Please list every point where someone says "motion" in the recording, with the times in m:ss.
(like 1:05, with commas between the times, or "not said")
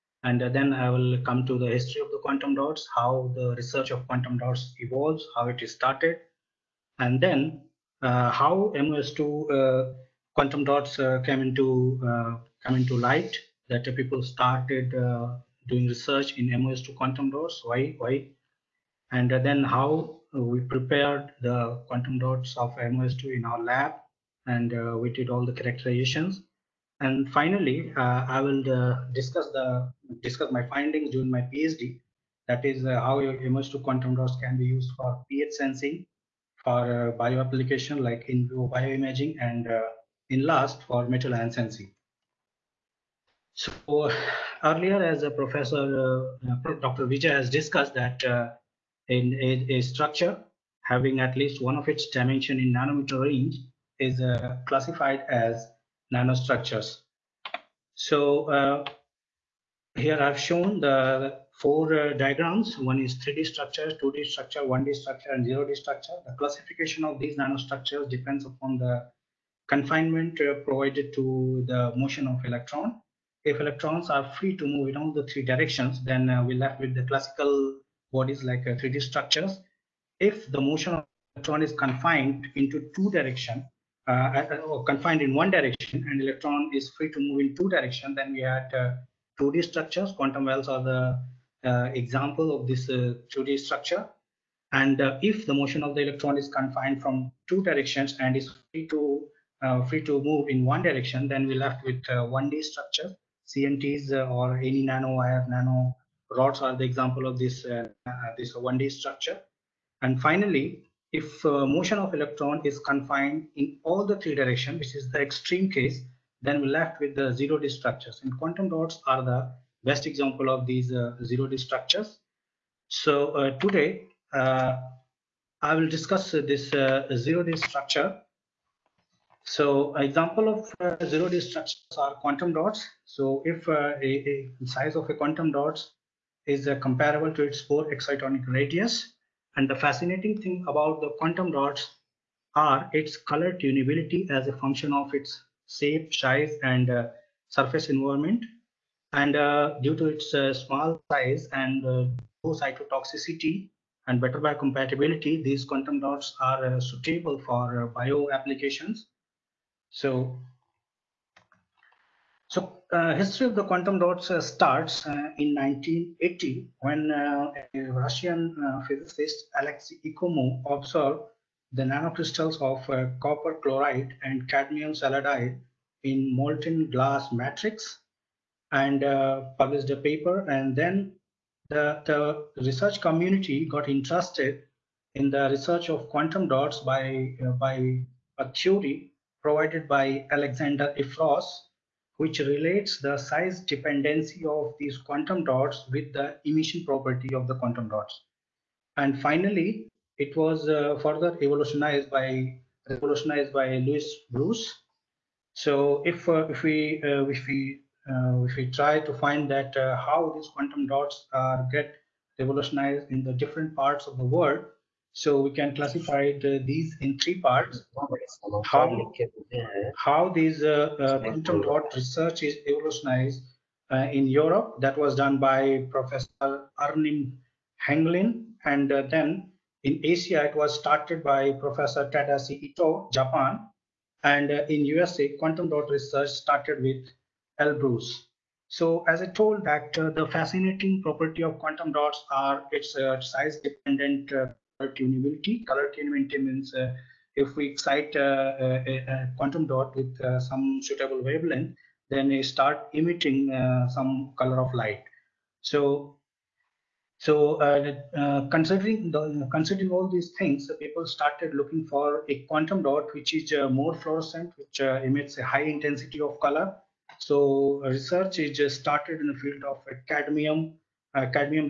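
1:11, 1:20, 1:35, 1:51.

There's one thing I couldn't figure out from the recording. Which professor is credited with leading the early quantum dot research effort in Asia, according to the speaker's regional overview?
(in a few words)
Tadashi Ito.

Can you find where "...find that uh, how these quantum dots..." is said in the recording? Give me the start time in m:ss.
3:29.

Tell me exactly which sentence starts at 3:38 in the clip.
How, how these uh, uh, quantum dot research is evolutionized uh, in Europe.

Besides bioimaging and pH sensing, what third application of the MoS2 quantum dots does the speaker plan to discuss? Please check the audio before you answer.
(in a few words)
metal ion sensing.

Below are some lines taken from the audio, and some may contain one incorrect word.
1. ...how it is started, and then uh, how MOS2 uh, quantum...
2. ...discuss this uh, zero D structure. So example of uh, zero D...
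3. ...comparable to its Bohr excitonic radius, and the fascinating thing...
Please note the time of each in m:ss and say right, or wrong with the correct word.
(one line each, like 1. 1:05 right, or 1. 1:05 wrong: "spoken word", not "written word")
1. 0:05 right
2. 2:05 right
3. 2:16 right.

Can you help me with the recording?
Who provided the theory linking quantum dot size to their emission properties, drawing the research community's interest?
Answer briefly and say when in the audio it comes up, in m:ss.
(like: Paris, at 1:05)
Alexander Efros, at 3:10.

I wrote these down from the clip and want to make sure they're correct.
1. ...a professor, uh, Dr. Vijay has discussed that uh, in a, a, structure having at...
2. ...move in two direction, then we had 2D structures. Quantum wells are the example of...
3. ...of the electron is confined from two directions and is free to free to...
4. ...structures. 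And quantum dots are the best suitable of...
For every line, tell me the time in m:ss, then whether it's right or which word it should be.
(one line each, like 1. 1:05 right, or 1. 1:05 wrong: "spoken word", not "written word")
1. 0:45 right
2. 1:27 right
3. 1:35 right
4. 1:57 wrong: "example", not "suitable".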